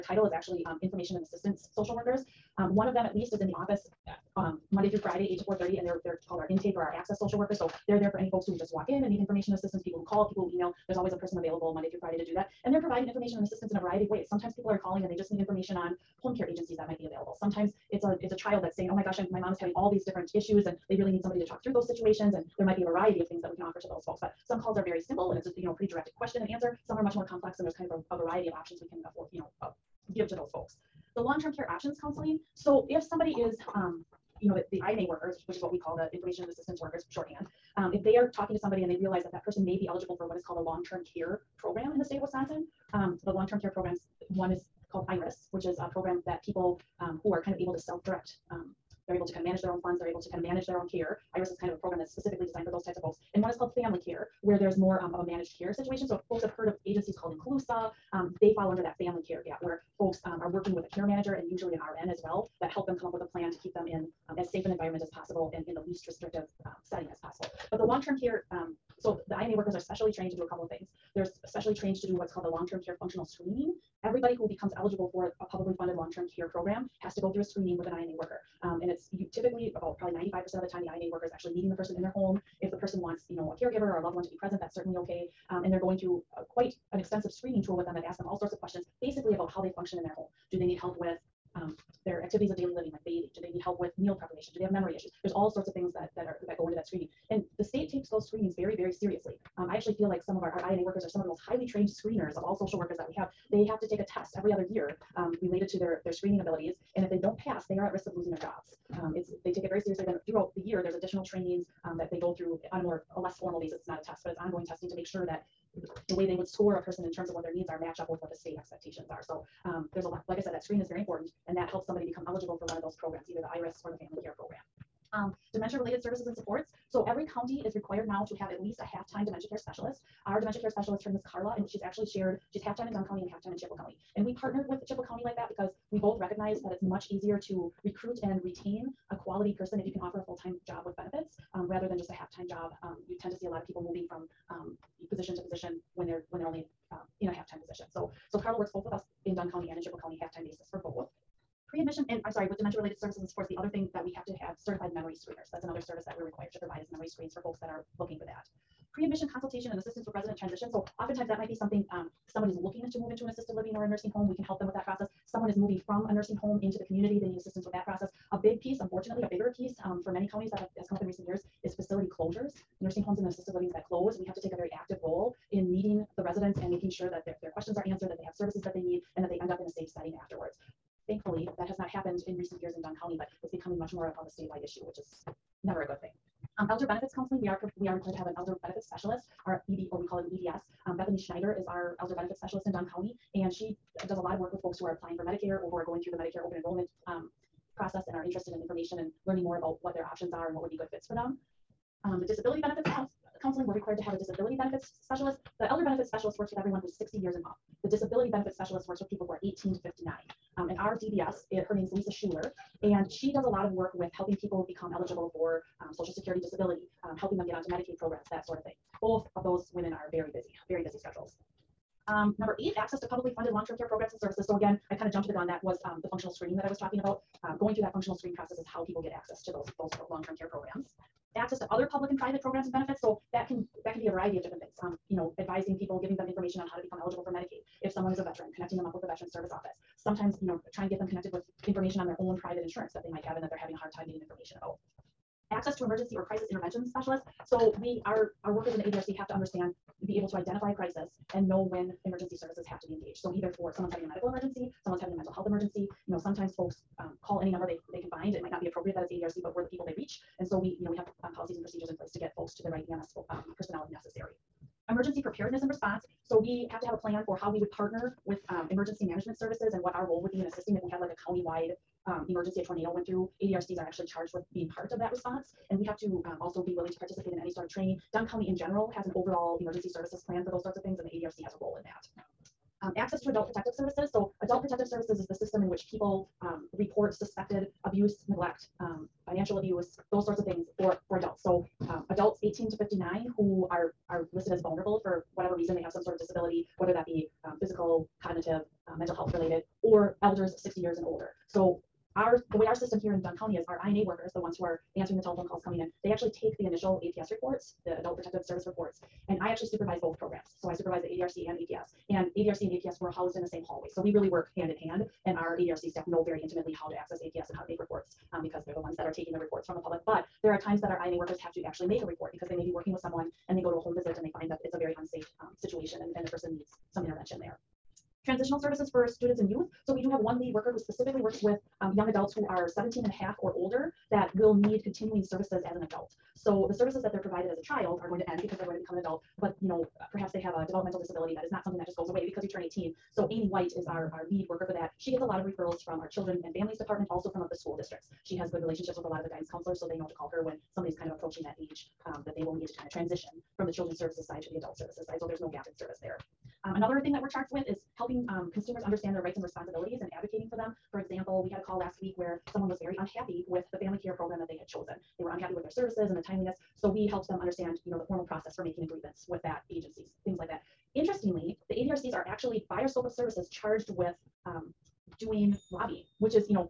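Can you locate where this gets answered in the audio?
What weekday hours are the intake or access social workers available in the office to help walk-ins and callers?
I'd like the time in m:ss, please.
0:05.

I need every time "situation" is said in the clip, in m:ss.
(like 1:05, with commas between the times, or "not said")
0:21, 0:55, 5:25.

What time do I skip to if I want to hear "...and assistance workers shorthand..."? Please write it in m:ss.
0:36.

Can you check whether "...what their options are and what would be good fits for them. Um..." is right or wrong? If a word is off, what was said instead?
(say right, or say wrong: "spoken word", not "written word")
right.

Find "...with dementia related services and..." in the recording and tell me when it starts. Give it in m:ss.
2:32.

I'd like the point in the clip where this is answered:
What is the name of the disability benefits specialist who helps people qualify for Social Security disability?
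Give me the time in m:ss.
3:31.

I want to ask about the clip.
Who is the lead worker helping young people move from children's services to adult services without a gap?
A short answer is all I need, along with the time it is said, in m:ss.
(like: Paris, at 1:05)
Amy White, at 5:43.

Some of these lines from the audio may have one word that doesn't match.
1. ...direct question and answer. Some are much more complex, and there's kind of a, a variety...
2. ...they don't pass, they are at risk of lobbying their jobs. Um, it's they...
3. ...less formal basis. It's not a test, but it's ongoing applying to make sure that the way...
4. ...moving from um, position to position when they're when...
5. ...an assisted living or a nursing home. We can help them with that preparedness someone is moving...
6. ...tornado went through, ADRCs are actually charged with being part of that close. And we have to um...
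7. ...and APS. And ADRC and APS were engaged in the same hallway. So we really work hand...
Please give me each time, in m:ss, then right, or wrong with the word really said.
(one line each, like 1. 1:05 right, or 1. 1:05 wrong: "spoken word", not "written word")
1. 0:25 right
2. 1:47 wrong: "losing", not "lobbying"
3. 1:53 wrong: "testing", not "applying"
4. 2:23 right
5. 2:43 wrong: "process", not "preparedness"
6. 4:32 wrong: "response", not "close"
7. 5:11 wrong: "housed", not "engaged".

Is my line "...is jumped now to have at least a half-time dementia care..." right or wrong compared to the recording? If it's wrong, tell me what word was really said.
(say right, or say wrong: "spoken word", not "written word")
wrong: "required", not "jumped".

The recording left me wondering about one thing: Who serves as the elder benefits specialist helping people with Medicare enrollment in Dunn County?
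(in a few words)
Bethany Schneider.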